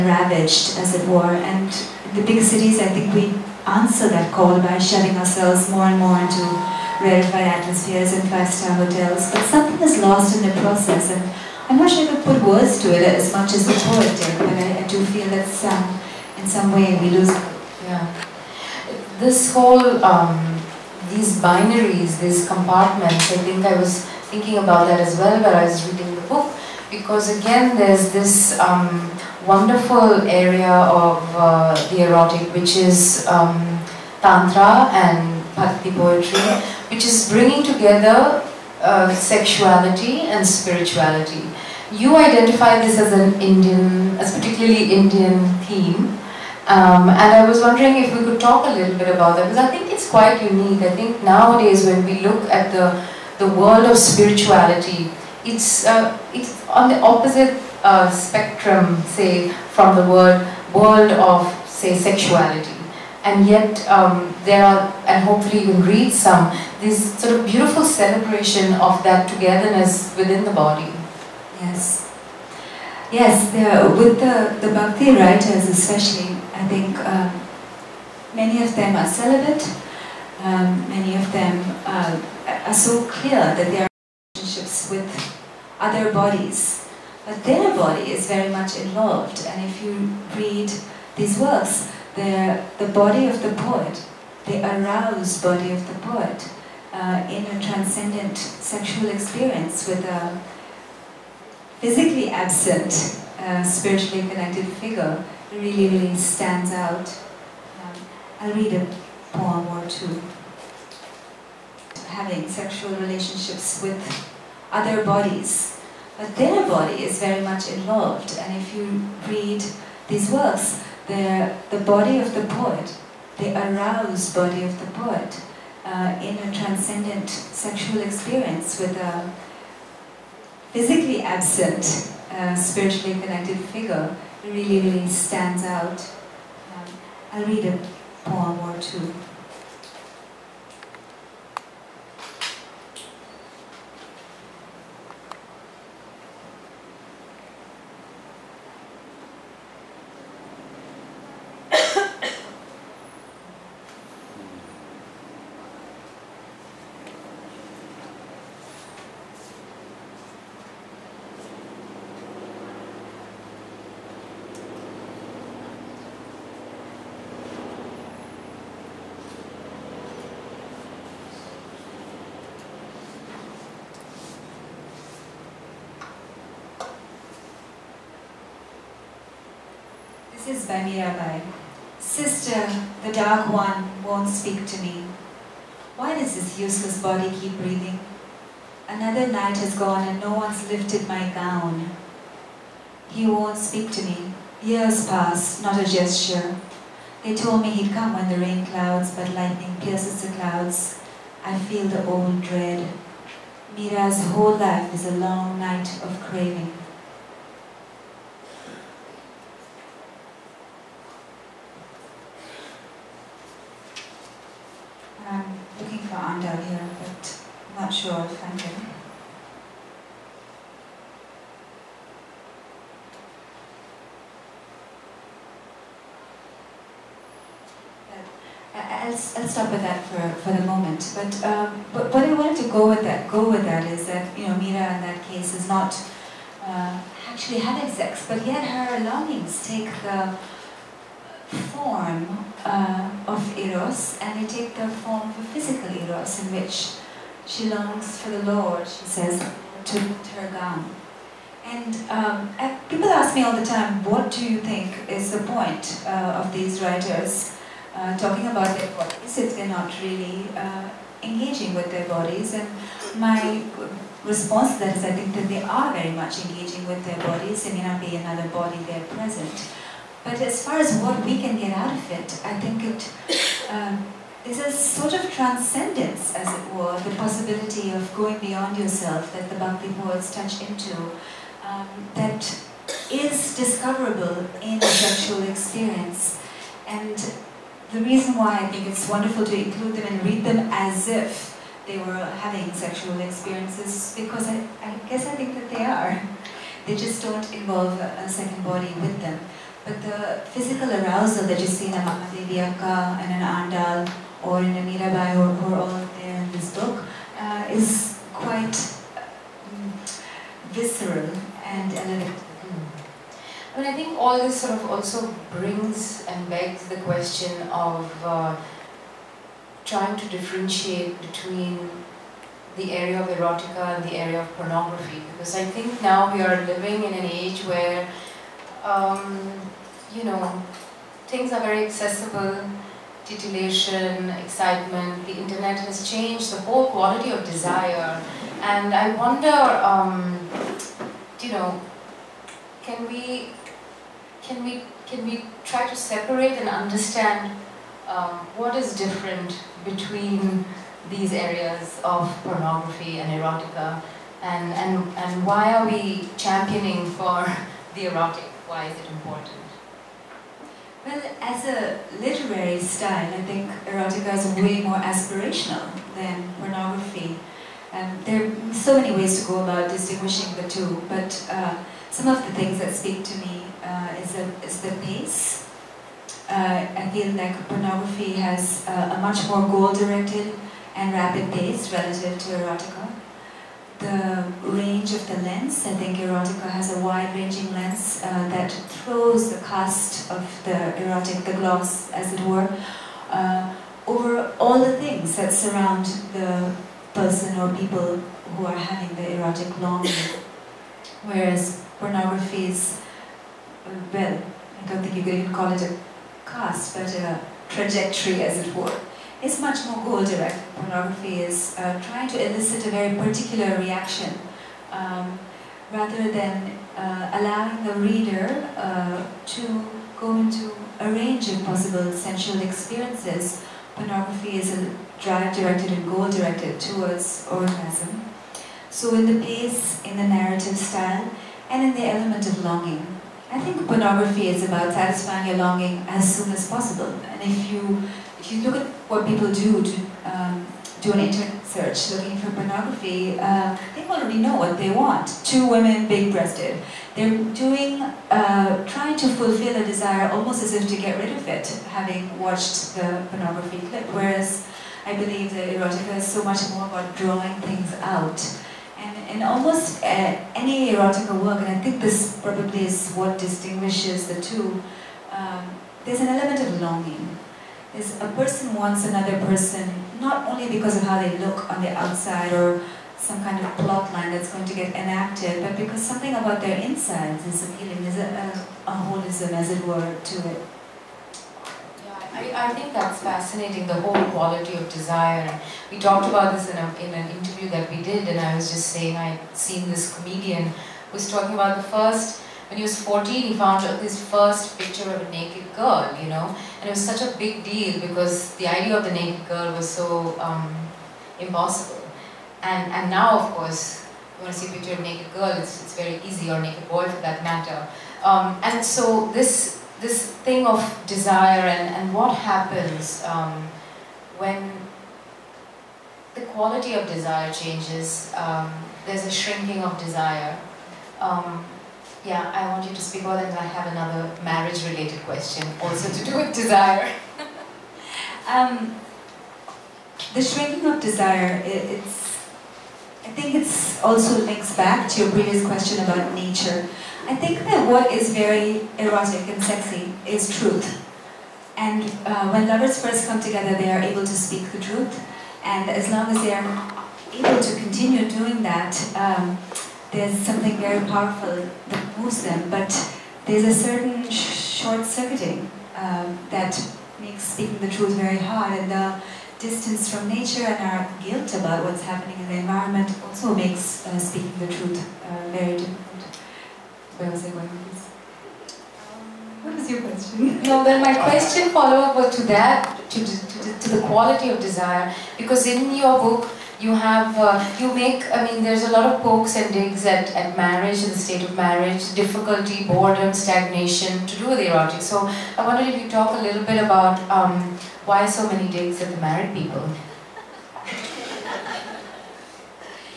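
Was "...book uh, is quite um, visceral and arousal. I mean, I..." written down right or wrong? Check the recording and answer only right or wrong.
wrong.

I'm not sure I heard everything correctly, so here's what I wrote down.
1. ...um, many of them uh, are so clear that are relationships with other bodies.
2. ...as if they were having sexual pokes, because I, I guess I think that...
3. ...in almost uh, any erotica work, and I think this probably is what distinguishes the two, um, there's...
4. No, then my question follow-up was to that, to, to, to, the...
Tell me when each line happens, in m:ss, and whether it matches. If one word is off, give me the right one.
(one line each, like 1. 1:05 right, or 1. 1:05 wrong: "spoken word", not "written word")
1. 1:20 right
2. 4:50 wrong: "experiences", not "pokes"
3. 7:39 right
4. 9:30 right.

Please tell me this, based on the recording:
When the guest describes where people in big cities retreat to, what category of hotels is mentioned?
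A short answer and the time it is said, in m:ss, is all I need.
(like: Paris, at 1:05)
five-star hotels, at 0:08.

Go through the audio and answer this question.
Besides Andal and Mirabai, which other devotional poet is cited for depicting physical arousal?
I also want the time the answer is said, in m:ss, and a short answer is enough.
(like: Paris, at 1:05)
Mahadevi Akka, at 5:01.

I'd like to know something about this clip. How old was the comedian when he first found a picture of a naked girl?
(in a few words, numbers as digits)
14.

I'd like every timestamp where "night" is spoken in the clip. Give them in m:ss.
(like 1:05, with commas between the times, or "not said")
3:09, 3:25.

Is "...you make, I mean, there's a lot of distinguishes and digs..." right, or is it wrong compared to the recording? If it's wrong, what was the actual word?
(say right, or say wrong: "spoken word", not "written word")
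wrong: "pokes", not "distinguishes".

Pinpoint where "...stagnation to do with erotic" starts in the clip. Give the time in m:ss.
9:43.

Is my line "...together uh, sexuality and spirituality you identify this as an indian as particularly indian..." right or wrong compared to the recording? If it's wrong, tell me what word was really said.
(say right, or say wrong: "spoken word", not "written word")
right.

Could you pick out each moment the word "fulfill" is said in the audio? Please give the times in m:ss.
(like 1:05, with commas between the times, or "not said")
7:29.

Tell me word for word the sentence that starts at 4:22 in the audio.
And my response to that is I think that they are very much engaging with their bodies.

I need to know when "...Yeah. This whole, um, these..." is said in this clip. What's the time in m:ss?
0:17.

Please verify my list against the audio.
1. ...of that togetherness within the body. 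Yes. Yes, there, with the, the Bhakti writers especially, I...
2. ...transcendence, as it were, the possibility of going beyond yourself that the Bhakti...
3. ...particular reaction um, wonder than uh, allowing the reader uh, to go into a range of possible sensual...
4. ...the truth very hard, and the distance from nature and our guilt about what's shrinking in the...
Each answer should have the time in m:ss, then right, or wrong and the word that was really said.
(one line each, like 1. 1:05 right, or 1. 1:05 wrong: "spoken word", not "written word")
1. 1:08 right
2. 4:35 right
3. 6:53 wrong: "rather", not "wonder"
4. 9:17 wrong: "happening", not "shrinking".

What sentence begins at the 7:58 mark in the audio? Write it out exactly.
Is a, a, a holism, as it were, to it.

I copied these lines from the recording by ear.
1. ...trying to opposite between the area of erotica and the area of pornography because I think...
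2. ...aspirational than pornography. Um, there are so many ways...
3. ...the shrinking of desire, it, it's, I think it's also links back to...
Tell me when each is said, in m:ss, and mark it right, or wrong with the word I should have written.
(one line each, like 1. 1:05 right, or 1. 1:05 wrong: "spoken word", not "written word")
1. 5:19 wrong: "differentiate", not "opposite"
2. 6:04 right
3. 8:50 right.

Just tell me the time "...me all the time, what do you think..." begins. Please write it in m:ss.
4:13.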